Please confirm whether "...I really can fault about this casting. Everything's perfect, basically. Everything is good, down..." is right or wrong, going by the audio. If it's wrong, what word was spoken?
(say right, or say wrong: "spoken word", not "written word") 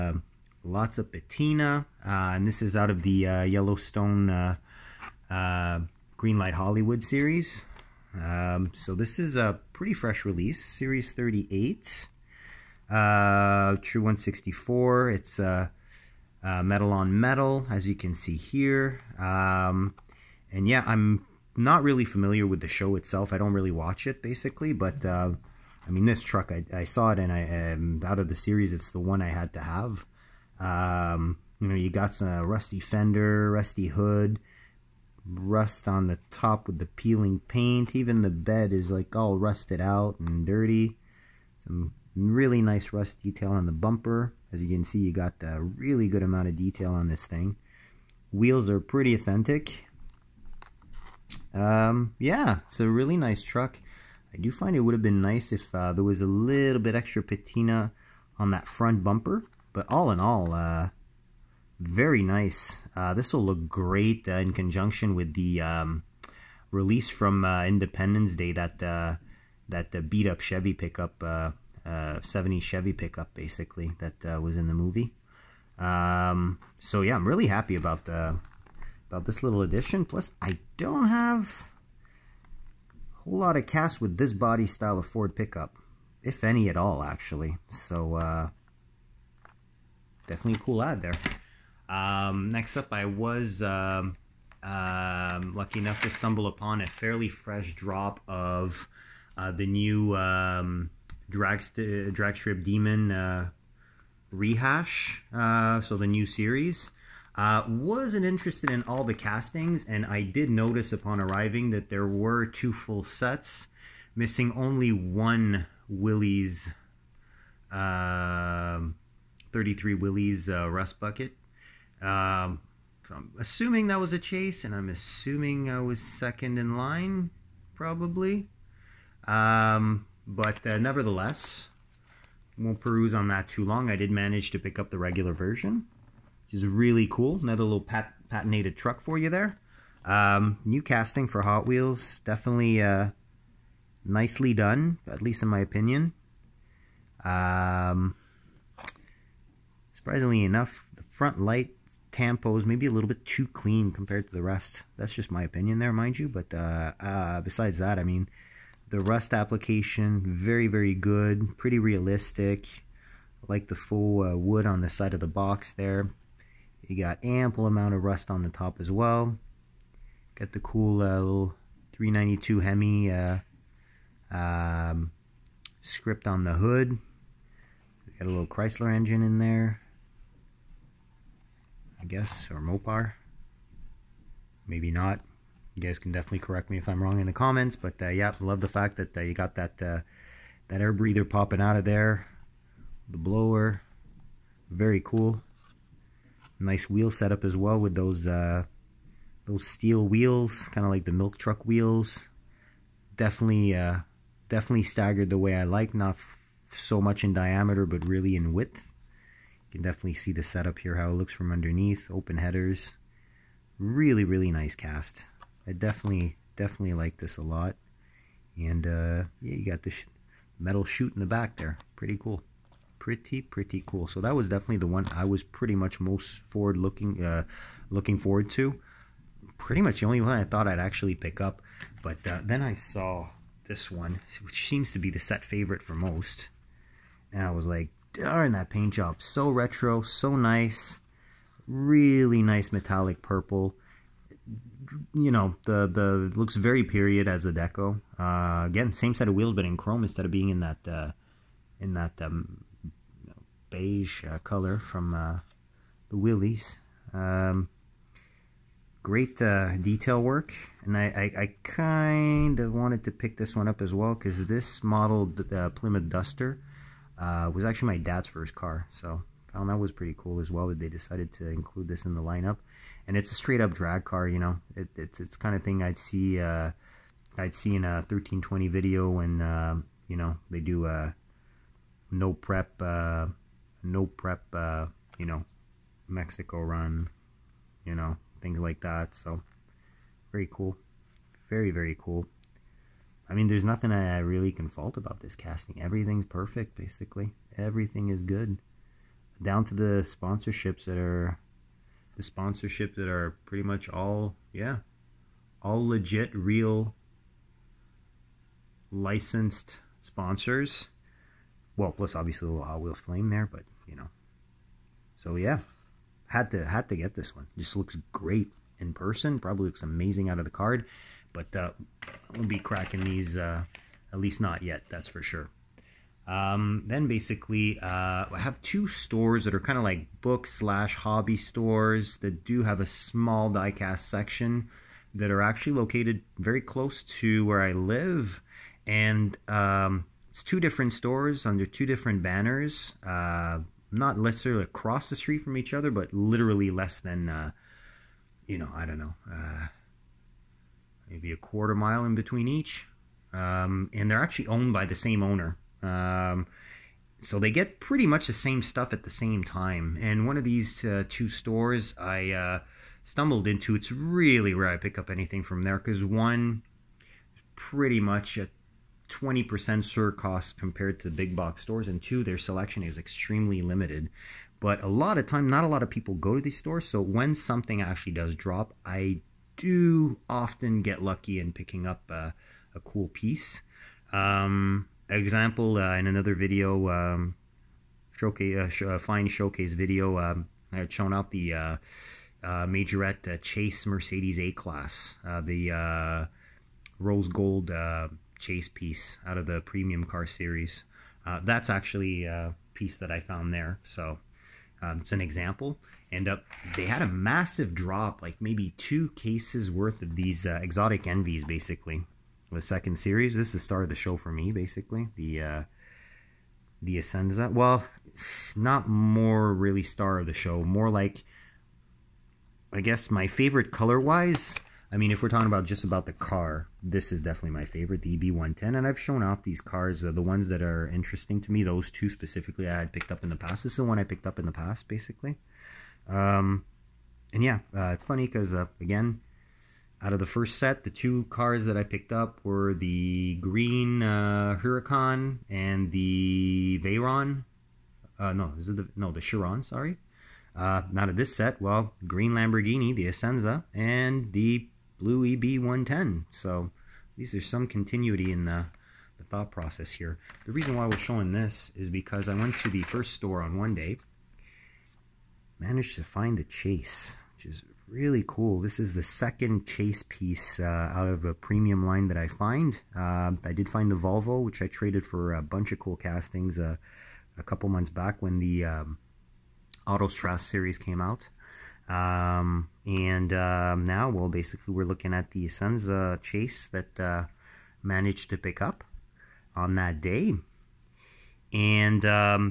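right.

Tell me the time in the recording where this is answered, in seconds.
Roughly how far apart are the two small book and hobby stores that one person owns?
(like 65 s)
351 s.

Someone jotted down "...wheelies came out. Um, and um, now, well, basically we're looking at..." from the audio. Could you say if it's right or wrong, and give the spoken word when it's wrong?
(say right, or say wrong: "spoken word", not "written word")
wrong: "series", not "wheelies".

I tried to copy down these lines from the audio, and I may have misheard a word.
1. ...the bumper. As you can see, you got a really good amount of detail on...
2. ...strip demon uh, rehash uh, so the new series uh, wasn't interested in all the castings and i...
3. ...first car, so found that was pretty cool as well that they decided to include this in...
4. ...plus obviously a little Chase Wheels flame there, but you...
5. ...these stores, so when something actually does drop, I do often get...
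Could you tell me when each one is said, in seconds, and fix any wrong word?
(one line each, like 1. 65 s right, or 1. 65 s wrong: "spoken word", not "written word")
1. 43 s right
2. 102 s right
3. 268 s right
4. 311 s wrong: "Hot", not "Chase"
5. 376 s right.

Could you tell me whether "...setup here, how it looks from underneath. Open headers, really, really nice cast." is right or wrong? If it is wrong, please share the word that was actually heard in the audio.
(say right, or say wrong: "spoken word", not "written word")
right.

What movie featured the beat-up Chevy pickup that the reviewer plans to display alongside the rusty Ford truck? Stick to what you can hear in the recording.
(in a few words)
Independence Day.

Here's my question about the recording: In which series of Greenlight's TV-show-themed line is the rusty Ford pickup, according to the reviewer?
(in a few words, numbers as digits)
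Series 38.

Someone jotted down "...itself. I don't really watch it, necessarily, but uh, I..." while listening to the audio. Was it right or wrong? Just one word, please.
wrong.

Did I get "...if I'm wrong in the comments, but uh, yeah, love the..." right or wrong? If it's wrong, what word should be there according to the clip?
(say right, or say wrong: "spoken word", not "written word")
right.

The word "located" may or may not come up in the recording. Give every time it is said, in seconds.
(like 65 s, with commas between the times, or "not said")
335 s.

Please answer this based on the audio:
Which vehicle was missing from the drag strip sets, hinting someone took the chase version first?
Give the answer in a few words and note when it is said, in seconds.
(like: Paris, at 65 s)
33 Willys, at 119 s.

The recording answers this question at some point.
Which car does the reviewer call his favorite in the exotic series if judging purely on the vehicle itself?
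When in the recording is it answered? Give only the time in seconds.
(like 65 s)
428 s.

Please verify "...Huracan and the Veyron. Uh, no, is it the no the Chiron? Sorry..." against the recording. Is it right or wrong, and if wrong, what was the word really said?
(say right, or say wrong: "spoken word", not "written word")
right.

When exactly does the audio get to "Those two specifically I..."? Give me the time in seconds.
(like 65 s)
431 s.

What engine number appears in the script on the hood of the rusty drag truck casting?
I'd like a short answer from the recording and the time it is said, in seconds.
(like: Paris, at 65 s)
392, at 171 s.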